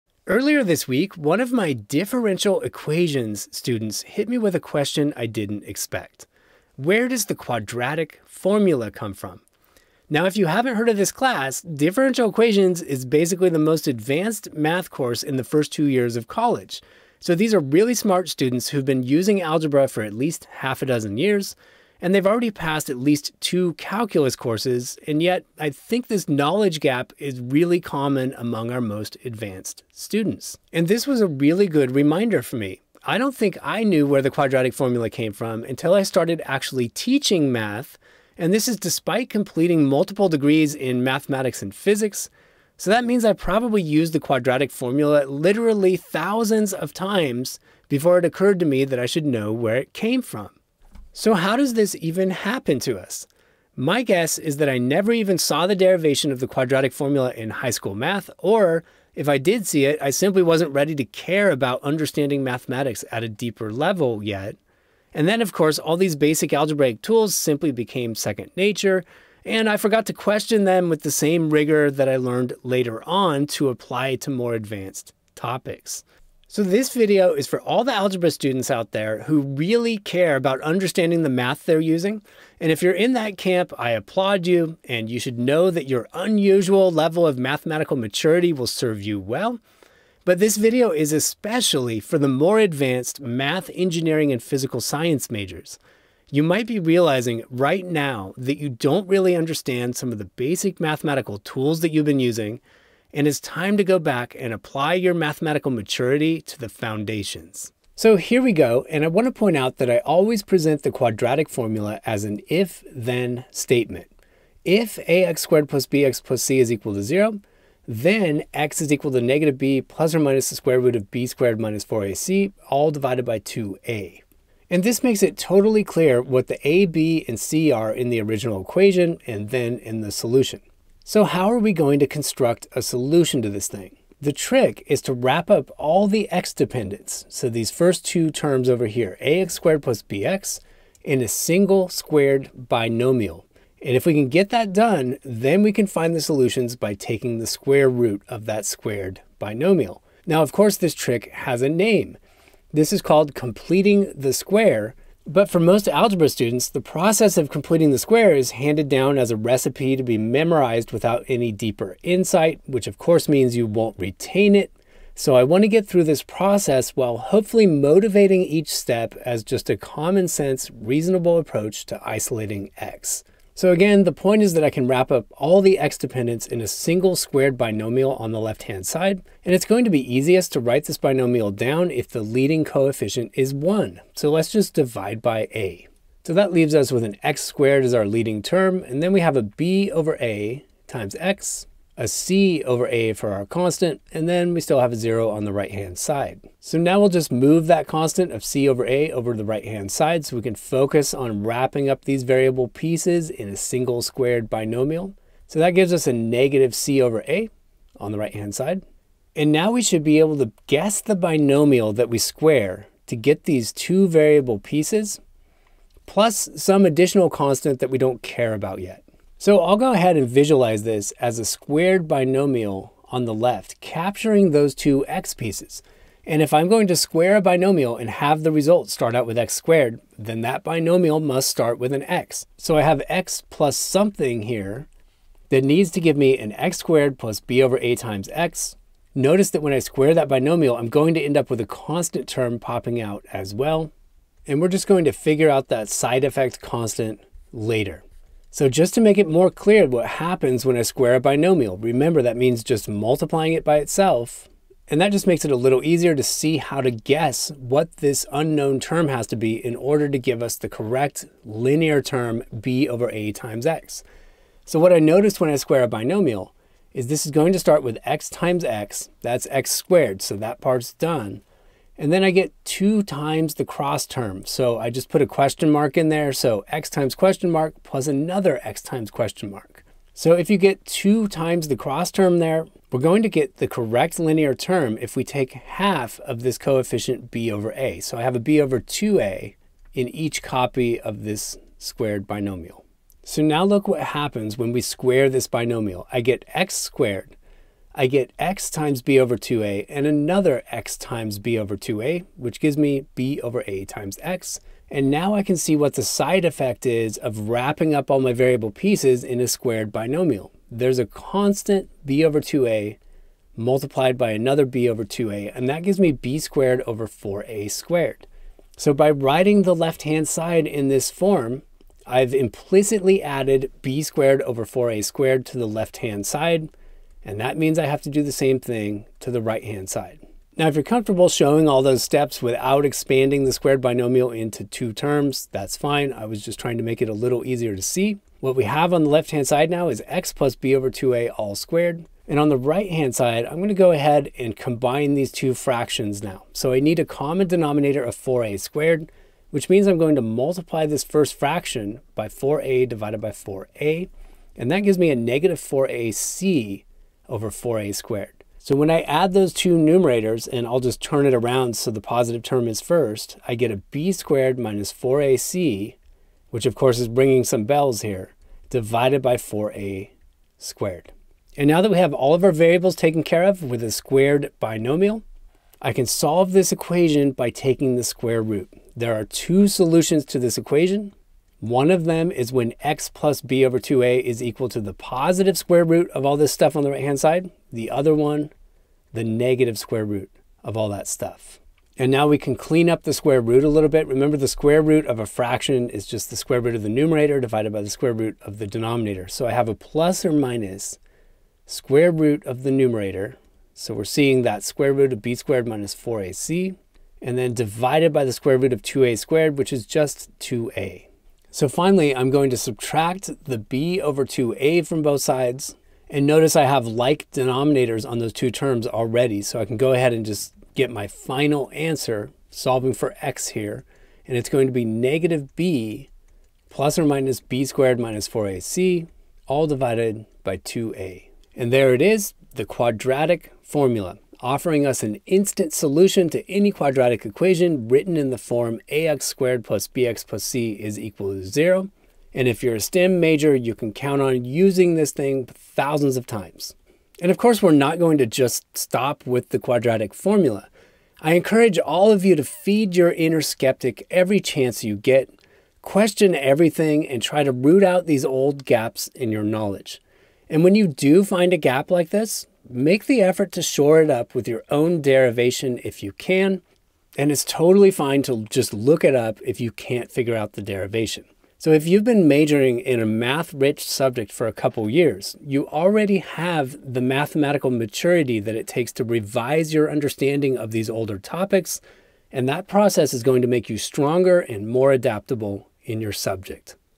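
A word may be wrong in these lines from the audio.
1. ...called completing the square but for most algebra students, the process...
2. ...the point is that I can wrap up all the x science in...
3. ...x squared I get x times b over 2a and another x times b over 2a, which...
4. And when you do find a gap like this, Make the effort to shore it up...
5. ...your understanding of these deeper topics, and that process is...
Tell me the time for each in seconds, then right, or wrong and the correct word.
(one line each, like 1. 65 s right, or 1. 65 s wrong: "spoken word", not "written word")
1. 153 s right
2. 174 s wrong: "dependence", not "science"
3. 296 s right
4. 460 s right
5. 479 s wrong: "older", not "deeper".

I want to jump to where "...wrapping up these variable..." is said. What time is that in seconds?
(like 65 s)
201 s.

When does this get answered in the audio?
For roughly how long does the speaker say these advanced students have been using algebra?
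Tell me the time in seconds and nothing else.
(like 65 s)
20 s.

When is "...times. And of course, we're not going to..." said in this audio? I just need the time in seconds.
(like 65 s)
446 s.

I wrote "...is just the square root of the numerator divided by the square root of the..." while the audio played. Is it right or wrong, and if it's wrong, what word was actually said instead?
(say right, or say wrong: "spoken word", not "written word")
right.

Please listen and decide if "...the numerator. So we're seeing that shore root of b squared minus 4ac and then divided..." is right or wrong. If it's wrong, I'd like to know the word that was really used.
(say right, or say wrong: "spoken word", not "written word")
wrong: "square", not "shore".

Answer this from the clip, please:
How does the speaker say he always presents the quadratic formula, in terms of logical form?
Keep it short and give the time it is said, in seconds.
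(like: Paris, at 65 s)
if-then statement, at 112 s.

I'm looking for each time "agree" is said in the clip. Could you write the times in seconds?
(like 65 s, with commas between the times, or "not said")
not said.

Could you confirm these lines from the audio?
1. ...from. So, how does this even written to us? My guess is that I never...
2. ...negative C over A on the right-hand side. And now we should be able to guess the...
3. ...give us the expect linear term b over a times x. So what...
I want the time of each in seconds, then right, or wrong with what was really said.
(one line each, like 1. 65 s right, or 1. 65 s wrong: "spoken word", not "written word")
1. 50 s wrong: "happen", not "written"
2. 206 s right
3. 260 s wrong: "correct", not "expect".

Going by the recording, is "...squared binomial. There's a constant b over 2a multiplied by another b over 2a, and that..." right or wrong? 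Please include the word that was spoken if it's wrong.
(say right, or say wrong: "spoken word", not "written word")
right.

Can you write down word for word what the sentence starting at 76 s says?
So this video is for all the algebra students out there who really care about understanding the math they're using.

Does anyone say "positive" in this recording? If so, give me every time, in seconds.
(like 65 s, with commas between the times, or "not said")
362 s, 384 s.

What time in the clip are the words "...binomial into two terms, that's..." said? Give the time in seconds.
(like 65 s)
333 s.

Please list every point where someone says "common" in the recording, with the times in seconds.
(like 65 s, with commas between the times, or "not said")
27 s, 169 s, 347 s.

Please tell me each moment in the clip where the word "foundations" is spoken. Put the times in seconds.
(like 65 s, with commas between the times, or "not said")
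106 s.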